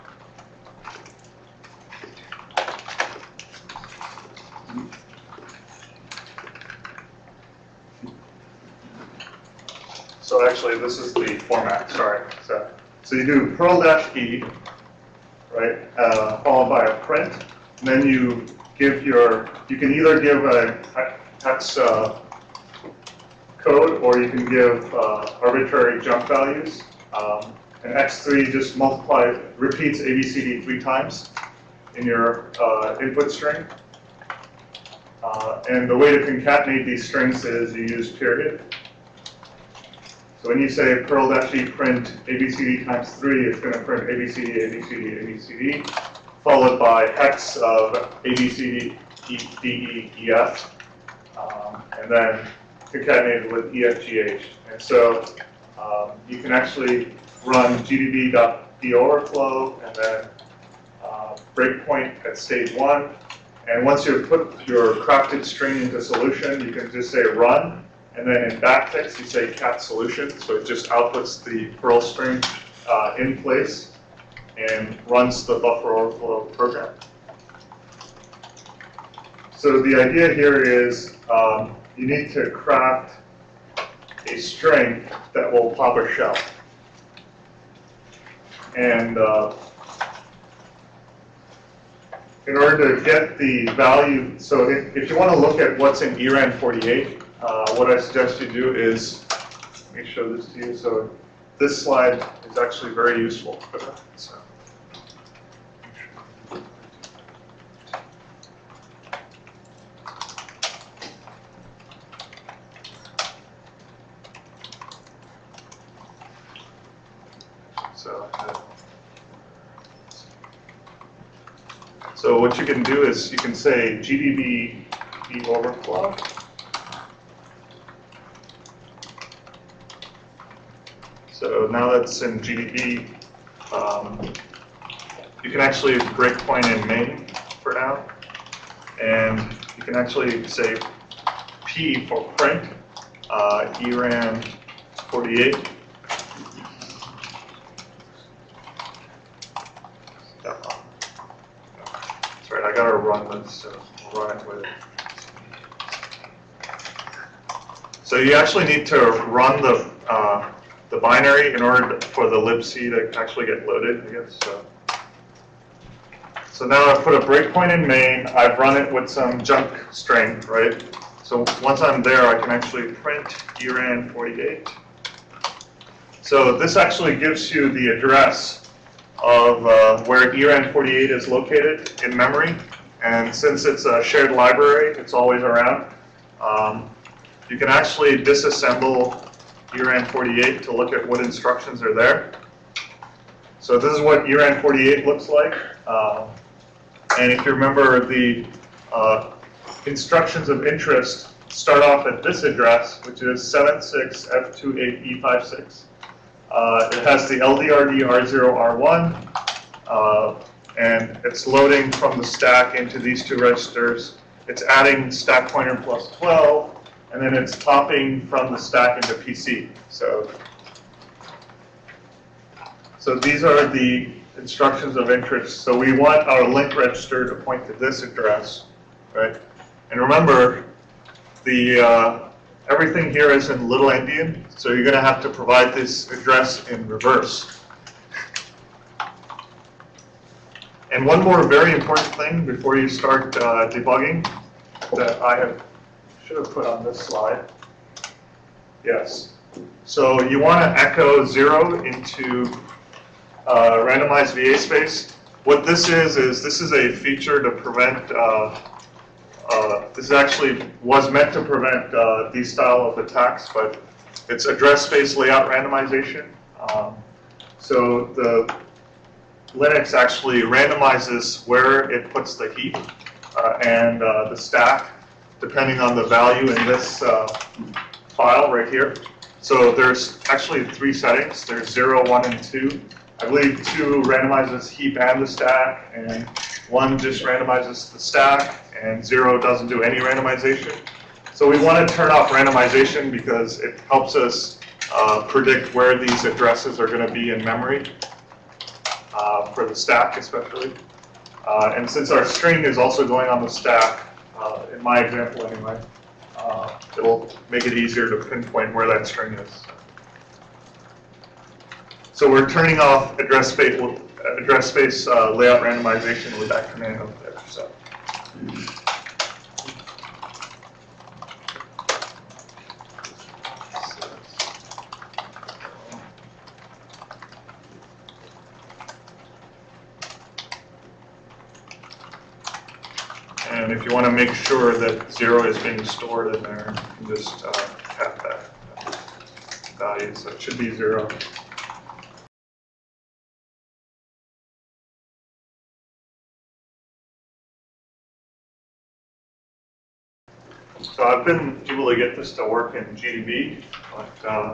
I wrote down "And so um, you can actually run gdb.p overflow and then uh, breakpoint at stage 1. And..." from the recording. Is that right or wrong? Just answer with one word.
right.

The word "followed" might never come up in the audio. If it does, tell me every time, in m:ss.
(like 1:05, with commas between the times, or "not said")
0:16, 0:46.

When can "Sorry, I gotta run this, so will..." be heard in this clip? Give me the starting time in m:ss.
2:32.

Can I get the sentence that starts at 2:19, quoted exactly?
And you can actually say P for print, uh, ERAM 48.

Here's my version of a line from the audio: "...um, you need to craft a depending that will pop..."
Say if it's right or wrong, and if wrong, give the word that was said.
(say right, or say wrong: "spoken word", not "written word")
wrong: "string", not "depending".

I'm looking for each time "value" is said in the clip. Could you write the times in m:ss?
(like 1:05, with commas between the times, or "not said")
0:26, 1:33, 4:36, 5:39.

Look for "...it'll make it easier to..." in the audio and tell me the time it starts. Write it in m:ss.
5:06.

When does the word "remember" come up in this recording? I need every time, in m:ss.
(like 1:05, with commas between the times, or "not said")
3:17, 3:49.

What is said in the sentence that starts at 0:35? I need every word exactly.
Uh, and the way to concatenate these strings is you use period.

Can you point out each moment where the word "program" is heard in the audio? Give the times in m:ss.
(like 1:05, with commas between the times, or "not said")
1:16.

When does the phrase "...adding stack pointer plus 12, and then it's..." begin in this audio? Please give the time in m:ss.
3:34.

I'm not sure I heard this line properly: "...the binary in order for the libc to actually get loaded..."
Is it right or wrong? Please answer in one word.
right.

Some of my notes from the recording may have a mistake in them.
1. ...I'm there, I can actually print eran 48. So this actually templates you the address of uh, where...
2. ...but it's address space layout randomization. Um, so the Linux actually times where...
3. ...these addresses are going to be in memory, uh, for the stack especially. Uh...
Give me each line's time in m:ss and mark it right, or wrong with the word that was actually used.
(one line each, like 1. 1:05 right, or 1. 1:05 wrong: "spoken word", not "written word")
1. 2:51 wrong: "gives", not "templates"
2. 4:23 wrong: "randomizes", not "times"
3. 4:55 right.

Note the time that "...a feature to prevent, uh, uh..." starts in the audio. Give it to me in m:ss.
4:16.